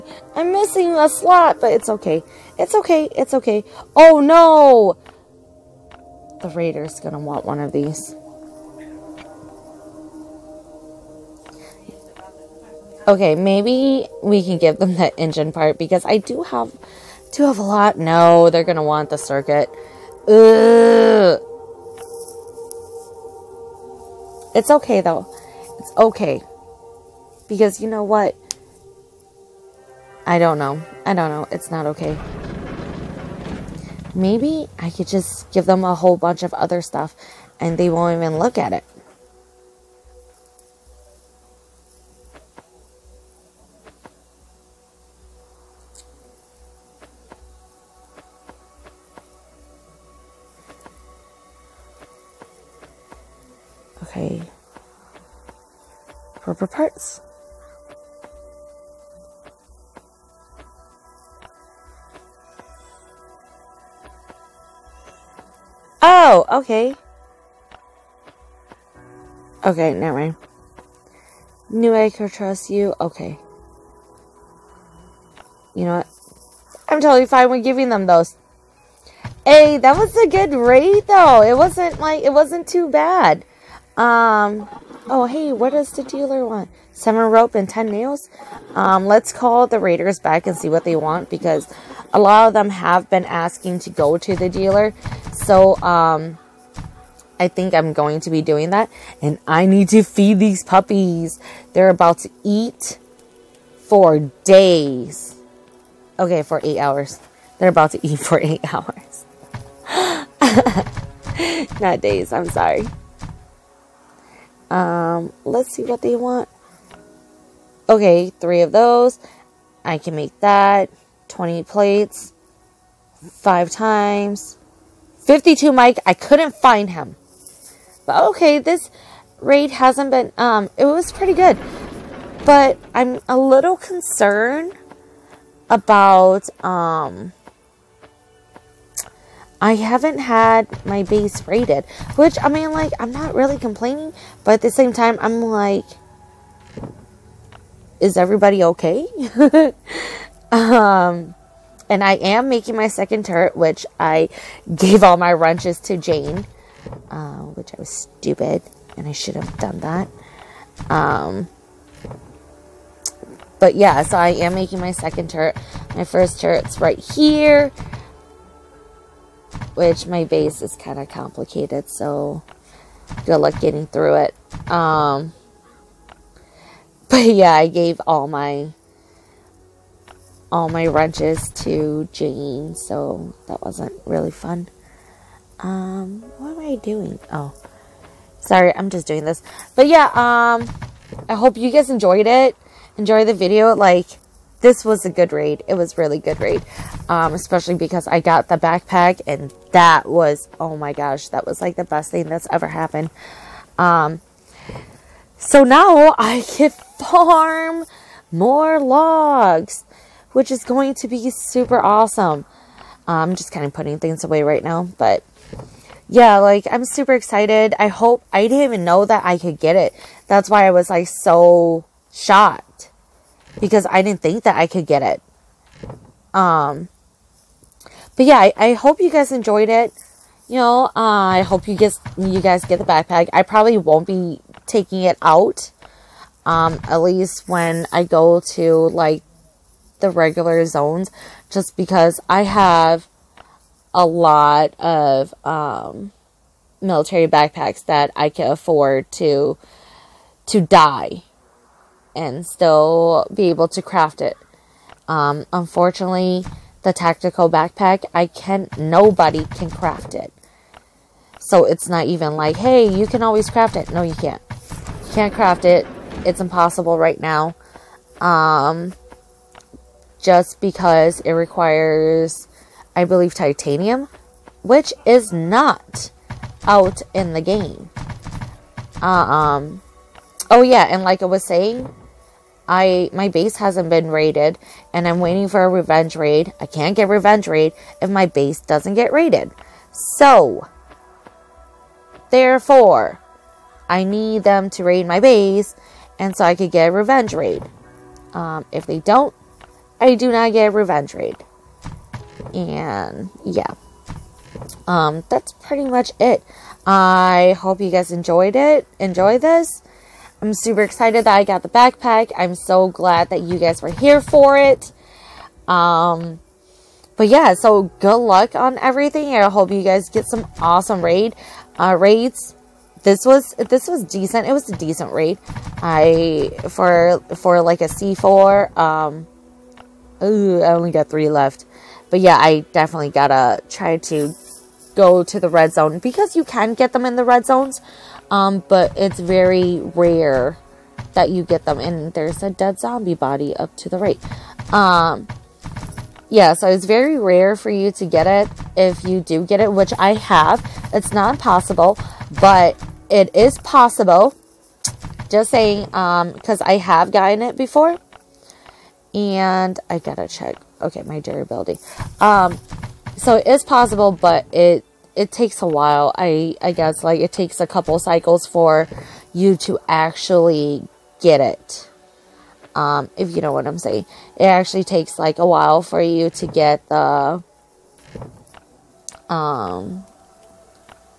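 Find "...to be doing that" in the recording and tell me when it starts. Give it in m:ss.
1:38.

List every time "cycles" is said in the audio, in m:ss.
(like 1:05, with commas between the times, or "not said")
6:07.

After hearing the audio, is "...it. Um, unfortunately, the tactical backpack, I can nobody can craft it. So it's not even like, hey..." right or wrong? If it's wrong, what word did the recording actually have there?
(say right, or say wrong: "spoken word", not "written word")
right.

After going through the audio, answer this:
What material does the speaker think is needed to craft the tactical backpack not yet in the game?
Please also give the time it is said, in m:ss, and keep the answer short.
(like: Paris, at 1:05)
titanium, at 4:33.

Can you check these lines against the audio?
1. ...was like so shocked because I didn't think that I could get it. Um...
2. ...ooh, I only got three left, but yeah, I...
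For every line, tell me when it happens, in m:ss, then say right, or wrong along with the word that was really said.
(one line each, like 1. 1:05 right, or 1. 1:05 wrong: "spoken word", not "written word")
1. 3:40 right
2. 5:30 right.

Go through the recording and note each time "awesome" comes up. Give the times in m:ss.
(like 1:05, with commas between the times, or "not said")
3:31, 5:20.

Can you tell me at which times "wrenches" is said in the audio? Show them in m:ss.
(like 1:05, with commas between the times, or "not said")
2:35, 3:00.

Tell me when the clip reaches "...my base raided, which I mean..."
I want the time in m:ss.
2:20.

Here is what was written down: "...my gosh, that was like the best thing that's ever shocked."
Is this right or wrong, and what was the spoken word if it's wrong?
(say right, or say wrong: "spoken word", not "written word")
wrong: "happened", not "shocked".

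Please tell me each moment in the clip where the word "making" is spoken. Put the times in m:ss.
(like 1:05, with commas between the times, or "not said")
2:32, 2:44.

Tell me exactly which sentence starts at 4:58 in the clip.
Um, if they don't, I do not get a revenge raid.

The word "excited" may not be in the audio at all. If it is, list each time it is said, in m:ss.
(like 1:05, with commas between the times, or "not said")
3:37, 5:10.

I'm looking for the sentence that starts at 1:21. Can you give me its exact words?
It wasn't like it wasn't too bad.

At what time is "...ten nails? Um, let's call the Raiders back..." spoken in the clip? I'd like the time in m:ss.
1:27.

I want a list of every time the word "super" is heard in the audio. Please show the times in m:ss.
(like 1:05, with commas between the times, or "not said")
3:31, 3:36, 5:10.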